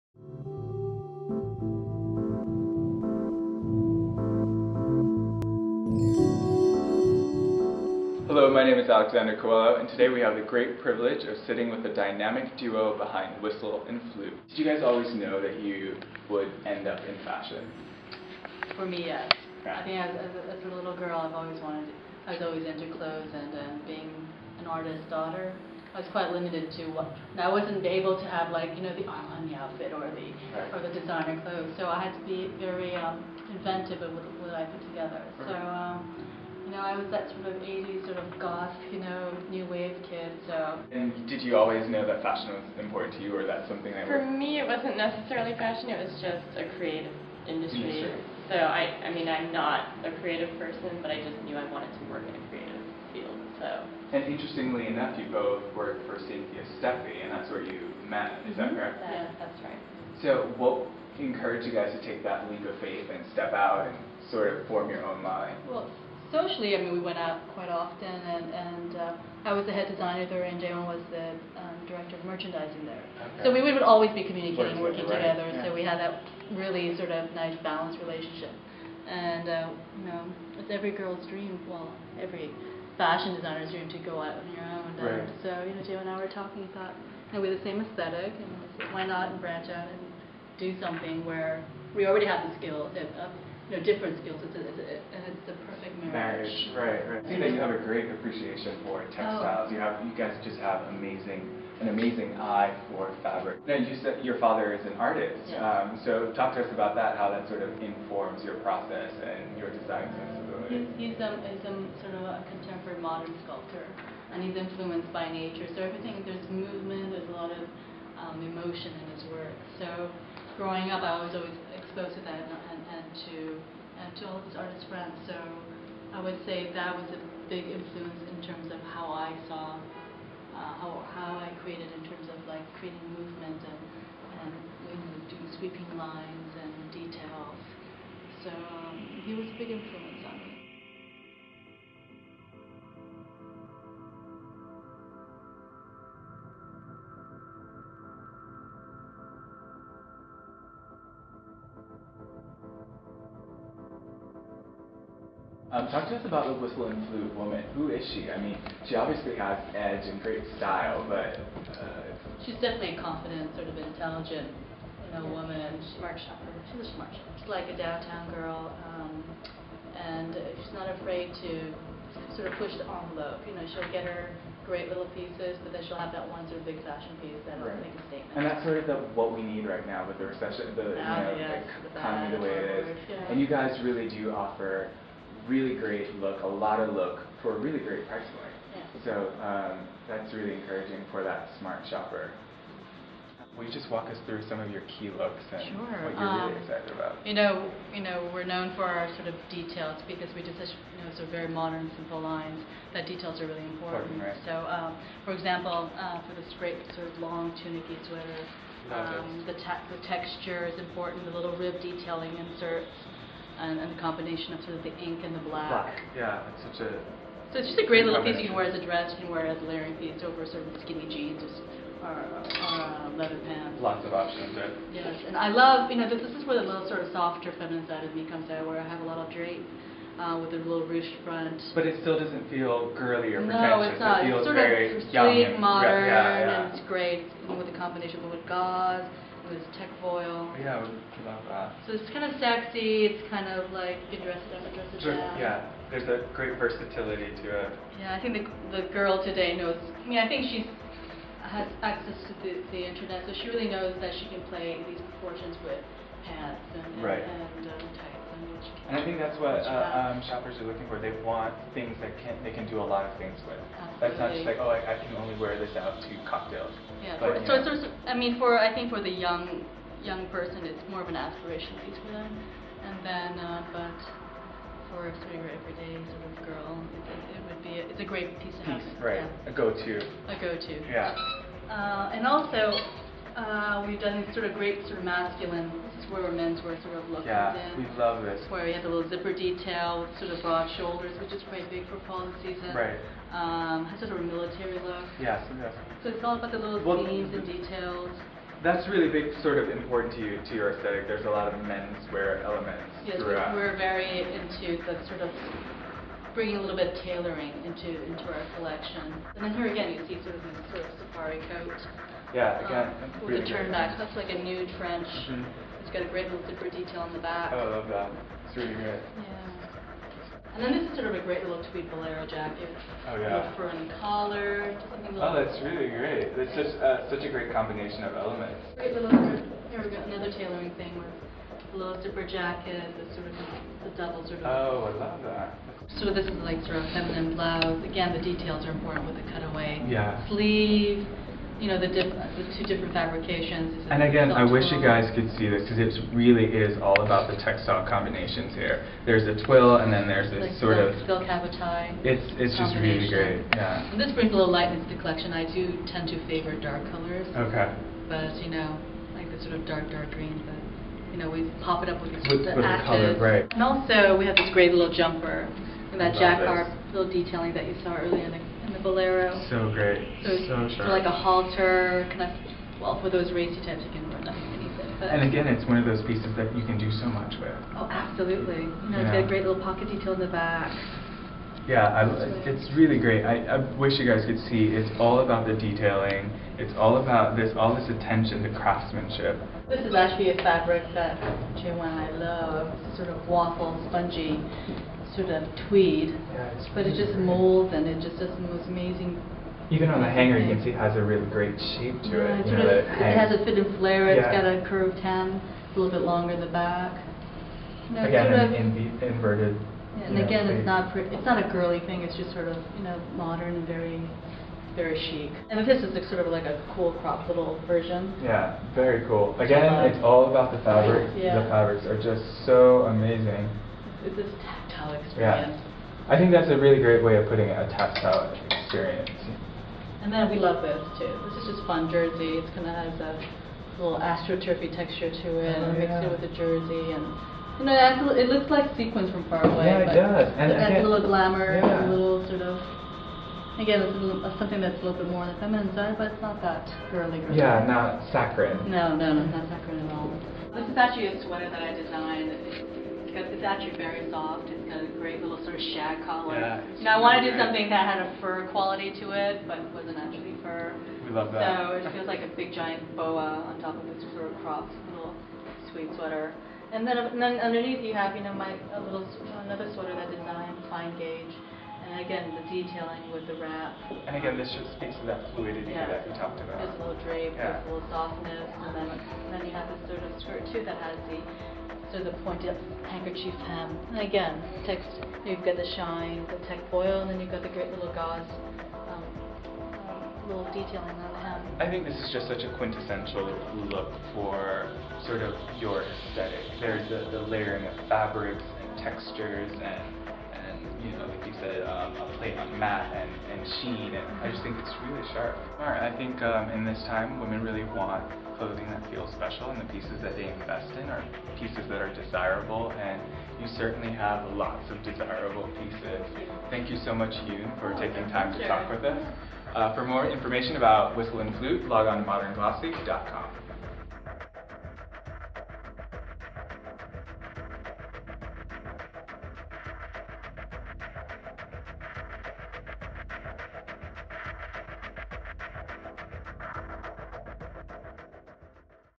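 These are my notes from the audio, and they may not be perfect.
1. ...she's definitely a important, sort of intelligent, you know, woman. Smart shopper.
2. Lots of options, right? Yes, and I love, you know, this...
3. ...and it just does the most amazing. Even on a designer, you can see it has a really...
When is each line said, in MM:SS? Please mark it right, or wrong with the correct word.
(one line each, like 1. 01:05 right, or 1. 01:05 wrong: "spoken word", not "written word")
1. 02:42 wrong: "confident", not "important"
2. 03:43 right
3. 06:37 wrong: "hanger", not "designer".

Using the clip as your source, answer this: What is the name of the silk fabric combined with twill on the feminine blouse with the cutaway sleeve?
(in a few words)
habotai.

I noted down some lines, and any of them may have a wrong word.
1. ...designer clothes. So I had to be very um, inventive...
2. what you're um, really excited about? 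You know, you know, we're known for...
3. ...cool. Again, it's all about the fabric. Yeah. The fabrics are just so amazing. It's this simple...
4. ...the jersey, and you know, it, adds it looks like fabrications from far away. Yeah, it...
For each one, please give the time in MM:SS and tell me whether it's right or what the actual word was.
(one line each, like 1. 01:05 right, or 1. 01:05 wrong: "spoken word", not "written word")
1. 00:30 right
2. 03:16 right
3. 06:59 wrong: "tactile", not "simple"
4. 07:16 wrong: "sequins", not "fabrications".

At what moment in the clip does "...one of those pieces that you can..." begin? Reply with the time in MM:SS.
06:15.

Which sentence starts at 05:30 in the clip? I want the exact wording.
Another tailoring thing with a little zipper jacket, the sort of the double sort of.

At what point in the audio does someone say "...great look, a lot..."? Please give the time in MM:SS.
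03:05.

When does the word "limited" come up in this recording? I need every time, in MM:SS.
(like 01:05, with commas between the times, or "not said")
00:26.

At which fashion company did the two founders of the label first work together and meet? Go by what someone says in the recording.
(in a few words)
Cynthia Steffe.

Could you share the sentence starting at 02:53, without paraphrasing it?
You know, she'll get her great little pieces, but then she'll have that one sort of big fashion piece that'll right.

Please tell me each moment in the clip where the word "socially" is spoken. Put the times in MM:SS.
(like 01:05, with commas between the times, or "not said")
01:06.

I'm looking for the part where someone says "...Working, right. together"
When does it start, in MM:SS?
01:14.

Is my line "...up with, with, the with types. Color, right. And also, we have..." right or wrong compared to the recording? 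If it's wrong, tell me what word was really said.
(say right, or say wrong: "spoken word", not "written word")
wrong: "ashes", not "types".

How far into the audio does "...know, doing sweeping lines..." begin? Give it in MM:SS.
02:14.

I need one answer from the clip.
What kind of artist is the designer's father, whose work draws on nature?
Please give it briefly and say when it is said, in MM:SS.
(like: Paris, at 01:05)
contemporary modern sculptor, at 01:52.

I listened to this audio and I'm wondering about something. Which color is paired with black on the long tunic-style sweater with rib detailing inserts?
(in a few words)
ink.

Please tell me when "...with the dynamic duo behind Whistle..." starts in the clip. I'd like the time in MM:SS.
00:11.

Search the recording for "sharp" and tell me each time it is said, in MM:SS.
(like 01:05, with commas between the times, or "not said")
06:10, 08:25.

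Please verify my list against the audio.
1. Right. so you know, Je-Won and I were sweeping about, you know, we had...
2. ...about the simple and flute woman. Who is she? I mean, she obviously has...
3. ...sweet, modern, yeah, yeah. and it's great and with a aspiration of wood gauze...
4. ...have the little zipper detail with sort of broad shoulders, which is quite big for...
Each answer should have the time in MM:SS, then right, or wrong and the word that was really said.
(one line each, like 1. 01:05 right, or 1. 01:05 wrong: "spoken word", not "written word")
1. 01:25 wrong: "talking", not "sweeping"
2. 02:36 wrong: "whistle", not "simple"
3. 03:55 wrong: "combination", not "aspiration"
4. 04:48 right.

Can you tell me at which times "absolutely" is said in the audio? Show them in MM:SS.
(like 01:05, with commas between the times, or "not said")
04:23, 06:17.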